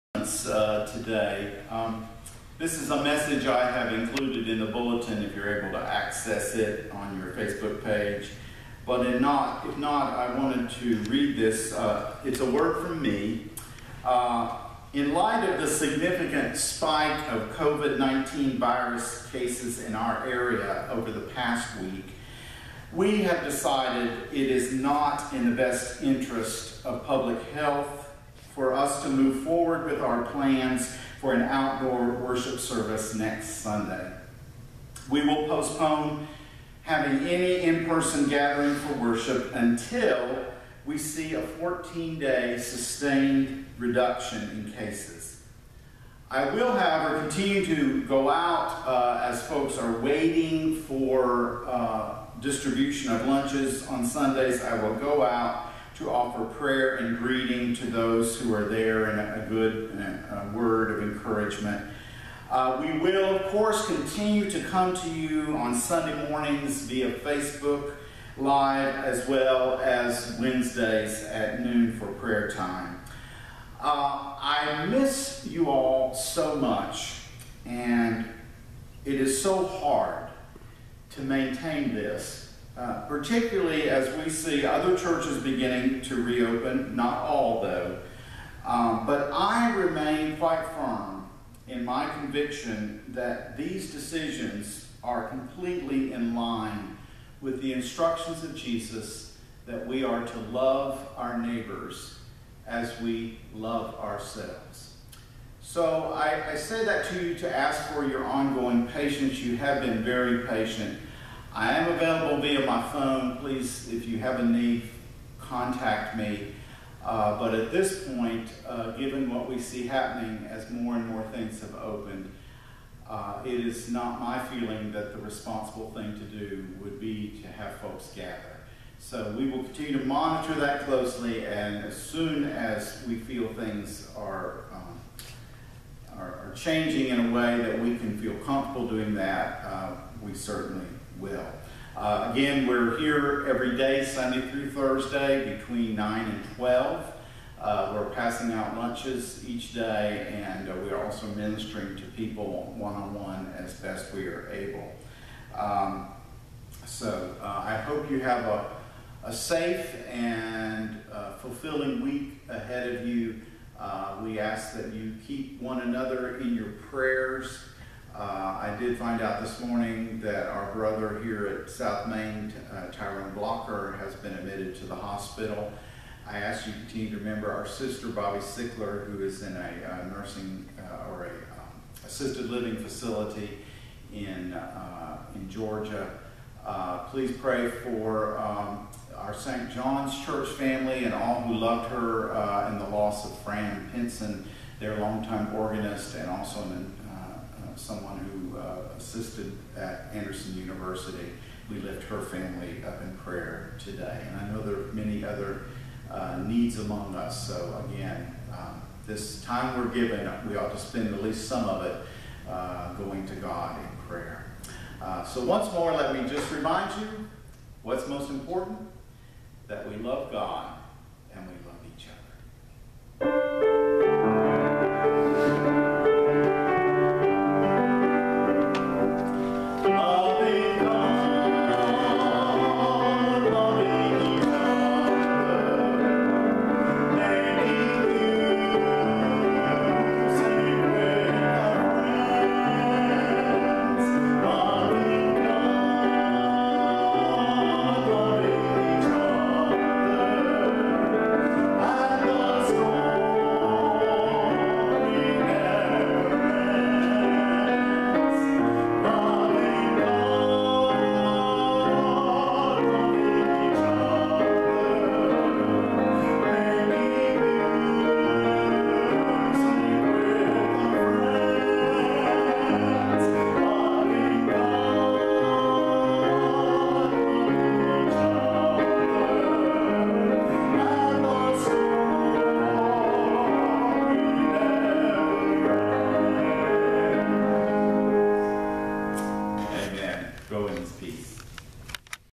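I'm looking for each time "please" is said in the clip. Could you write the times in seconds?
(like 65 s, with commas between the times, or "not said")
113 s, 187 s.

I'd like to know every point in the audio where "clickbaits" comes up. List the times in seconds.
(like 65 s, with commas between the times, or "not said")
not said.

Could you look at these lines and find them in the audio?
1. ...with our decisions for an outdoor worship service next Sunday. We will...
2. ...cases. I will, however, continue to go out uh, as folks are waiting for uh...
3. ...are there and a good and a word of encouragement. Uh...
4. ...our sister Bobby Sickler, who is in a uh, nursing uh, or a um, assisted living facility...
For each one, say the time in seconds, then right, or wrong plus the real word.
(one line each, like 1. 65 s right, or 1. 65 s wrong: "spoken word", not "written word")
1. 29 s wrong: "plans", not "decisions"
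2. 44 s right
3. 58 s right
4. 177 s right.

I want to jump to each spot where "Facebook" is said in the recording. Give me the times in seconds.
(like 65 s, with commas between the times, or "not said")
7 s, 67 s.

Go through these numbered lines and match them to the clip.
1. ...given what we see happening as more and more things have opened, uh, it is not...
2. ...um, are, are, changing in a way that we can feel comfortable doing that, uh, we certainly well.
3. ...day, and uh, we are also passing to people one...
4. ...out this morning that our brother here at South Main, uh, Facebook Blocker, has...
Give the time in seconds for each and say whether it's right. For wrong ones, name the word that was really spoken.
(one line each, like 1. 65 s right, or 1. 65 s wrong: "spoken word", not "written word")
1. 118 s right
2. 134 s right
3. 149 s wrong: "ministering", not "passing"
4. 169 s wrong: "Tyrone", not "Facebook".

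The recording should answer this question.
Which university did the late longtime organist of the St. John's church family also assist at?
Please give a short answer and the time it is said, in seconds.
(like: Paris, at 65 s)
Anderson University, at 200 s.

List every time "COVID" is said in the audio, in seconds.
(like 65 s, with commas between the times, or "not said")
17 s.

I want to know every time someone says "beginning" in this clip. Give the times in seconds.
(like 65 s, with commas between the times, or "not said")
85 s.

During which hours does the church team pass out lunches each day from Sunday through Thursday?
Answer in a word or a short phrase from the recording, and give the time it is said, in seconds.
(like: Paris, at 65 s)
9 to 12, at 145 s.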